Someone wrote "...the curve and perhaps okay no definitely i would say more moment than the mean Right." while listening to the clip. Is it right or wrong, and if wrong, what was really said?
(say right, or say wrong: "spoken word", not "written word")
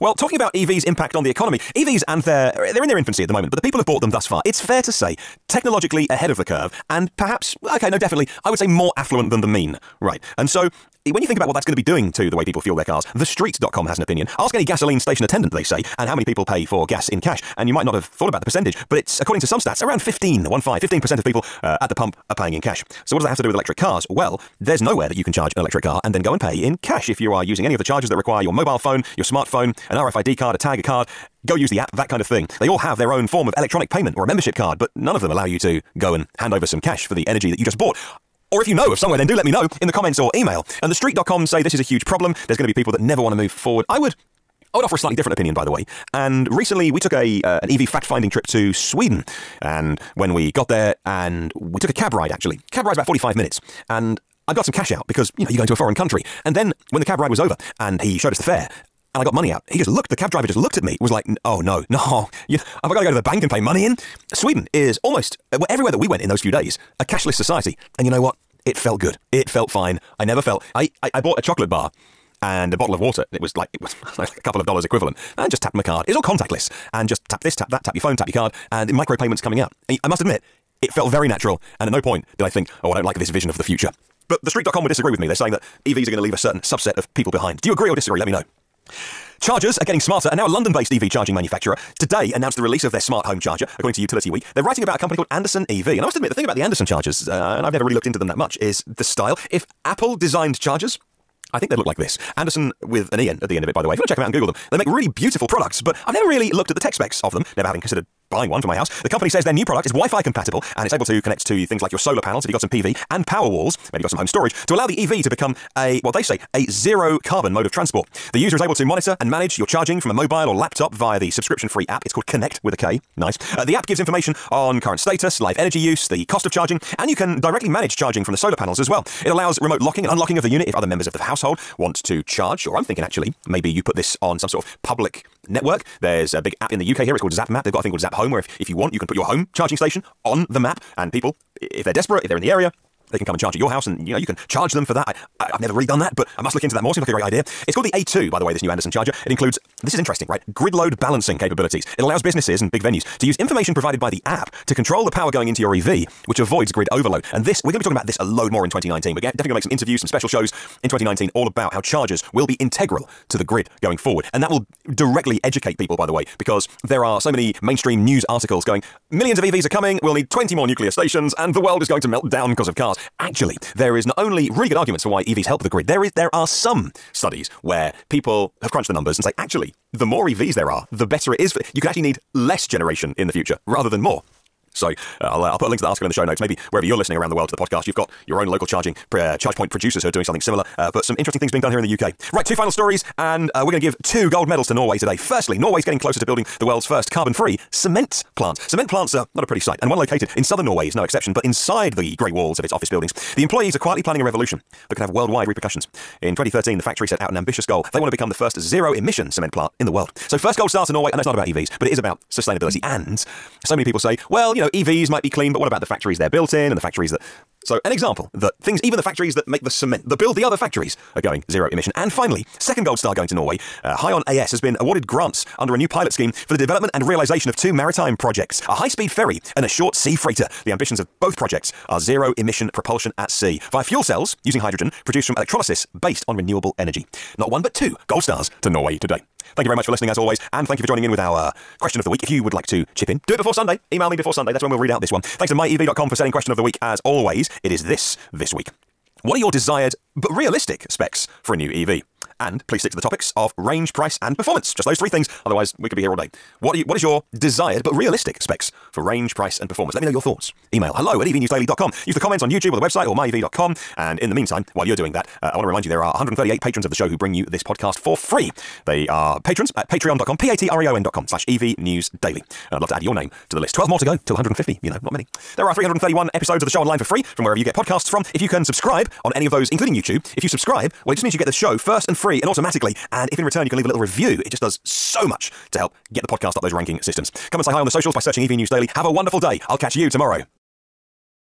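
wrong: "affluent", not "moment".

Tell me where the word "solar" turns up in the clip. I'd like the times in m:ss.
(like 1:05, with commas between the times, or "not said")
1:51, 2:08.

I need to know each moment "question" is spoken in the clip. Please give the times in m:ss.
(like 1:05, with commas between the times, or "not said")
4:01, 4:06.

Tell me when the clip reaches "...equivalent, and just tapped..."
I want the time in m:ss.
1:14.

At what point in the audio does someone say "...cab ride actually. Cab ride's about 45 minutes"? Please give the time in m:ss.
0:51.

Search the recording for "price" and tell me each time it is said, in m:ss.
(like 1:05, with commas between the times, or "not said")
4:13, 4:19.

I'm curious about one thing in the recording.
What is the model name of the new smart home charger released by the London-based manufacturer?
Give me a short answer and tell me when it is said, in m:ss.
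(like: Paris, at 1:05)
A2, at 2:27.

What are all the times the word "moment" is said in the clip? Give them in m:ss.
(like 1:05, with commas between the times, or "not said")
0:03.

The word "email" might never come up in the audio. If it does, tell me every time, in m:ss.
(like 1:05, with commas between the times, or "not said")
0:40, 4:03, 4:20.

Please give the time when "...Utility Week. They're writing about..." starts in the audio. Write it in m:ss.
1:33.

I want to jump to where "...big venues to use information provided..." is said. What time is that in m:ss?
2:32.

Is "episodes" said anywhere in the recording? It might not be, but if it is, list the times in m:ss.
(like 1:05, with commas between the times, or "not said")
4:36.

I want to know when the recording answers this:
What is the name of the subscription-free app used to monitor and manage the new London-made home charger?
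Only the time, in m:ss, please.
2:02.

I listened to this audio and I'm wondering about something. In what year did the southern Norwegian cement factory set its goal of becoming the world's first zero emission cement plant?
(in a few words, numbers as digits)
2013.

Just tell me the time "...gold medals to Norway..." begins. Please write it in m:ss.
3:14.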